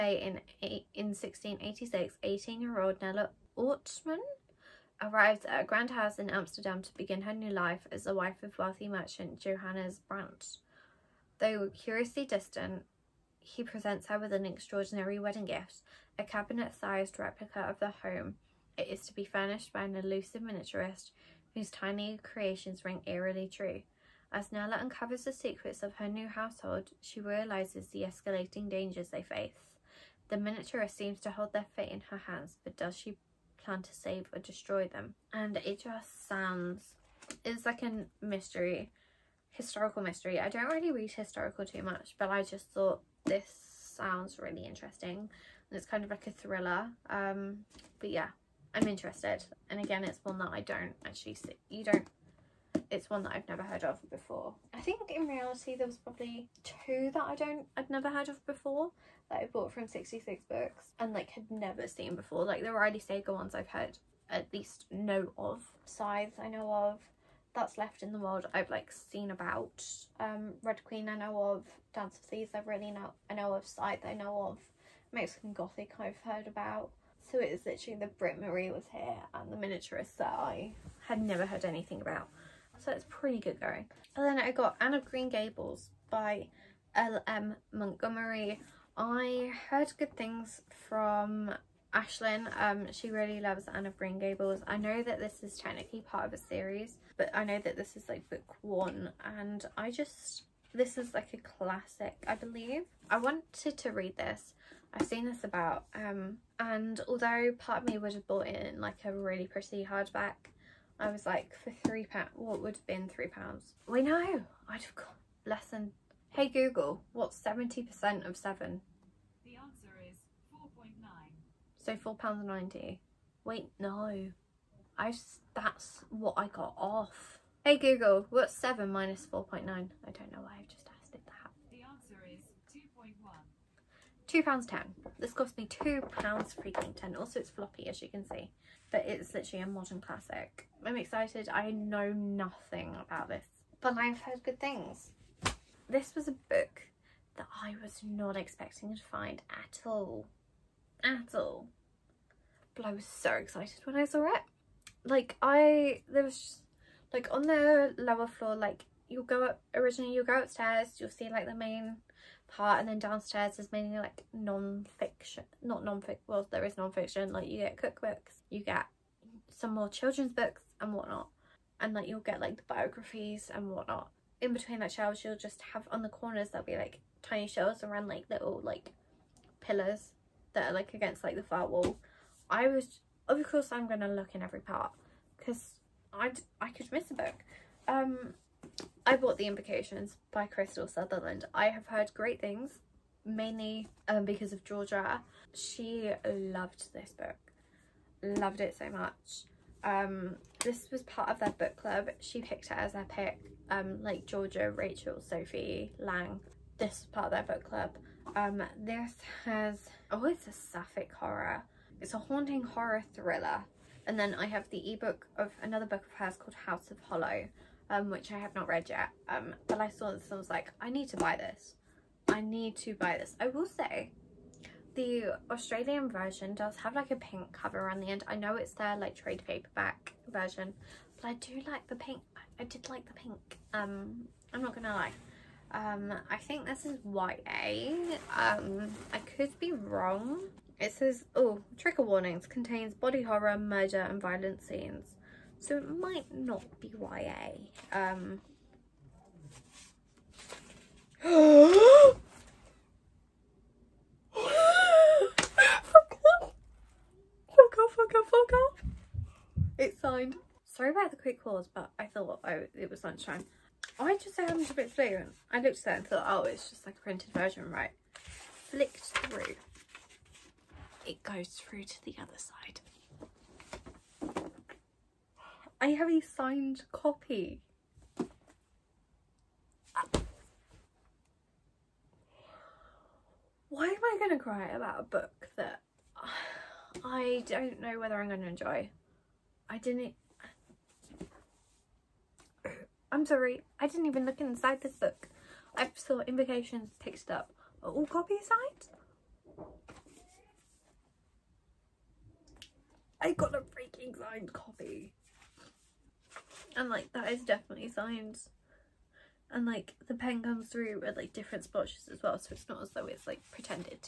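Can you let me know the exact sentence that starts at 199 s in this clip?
Um, this was part of their book club.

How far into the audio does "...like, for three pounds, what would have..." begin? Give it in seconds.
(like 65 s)
111 s.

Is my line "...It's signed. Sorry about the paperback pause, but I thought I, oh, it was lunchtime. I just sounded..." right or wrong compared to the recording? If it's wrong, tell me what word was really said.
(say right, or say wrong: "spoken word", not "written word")
wrong: "quick", not "paperback".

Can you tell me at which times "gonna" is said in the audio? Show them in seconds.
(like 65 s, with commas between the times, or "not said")
183 s, 234 s.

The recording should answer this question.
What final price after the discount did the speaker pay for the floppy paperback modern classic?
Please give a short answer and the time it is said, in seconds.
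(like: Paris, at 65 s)
£2.10, at 134 s.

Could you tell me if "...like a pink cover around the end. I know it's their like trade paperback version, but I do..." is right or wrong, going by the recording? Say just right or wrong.
right.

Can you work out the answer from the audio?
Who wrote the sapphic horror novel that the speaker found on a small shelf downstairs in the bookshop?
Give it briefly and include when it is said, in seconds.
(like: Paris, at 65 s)
Krystal Sutherland, at 190 s.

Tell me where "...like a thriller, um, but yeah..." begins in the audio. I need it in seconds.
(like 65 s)
46 s.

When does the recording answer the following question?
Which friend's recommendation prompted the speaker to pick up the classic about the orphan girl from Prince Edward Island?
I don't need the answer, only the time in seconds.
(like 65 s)
91 s.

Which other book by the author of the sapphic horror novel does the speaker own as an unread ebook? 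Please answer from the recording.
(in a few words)
House of Hollow.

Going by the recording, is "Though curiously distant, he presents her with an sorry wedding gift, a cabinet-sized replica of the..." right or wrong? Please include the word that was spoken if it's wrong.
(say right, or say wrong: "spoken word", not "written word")
wrong: "extraordinary", not "sorry".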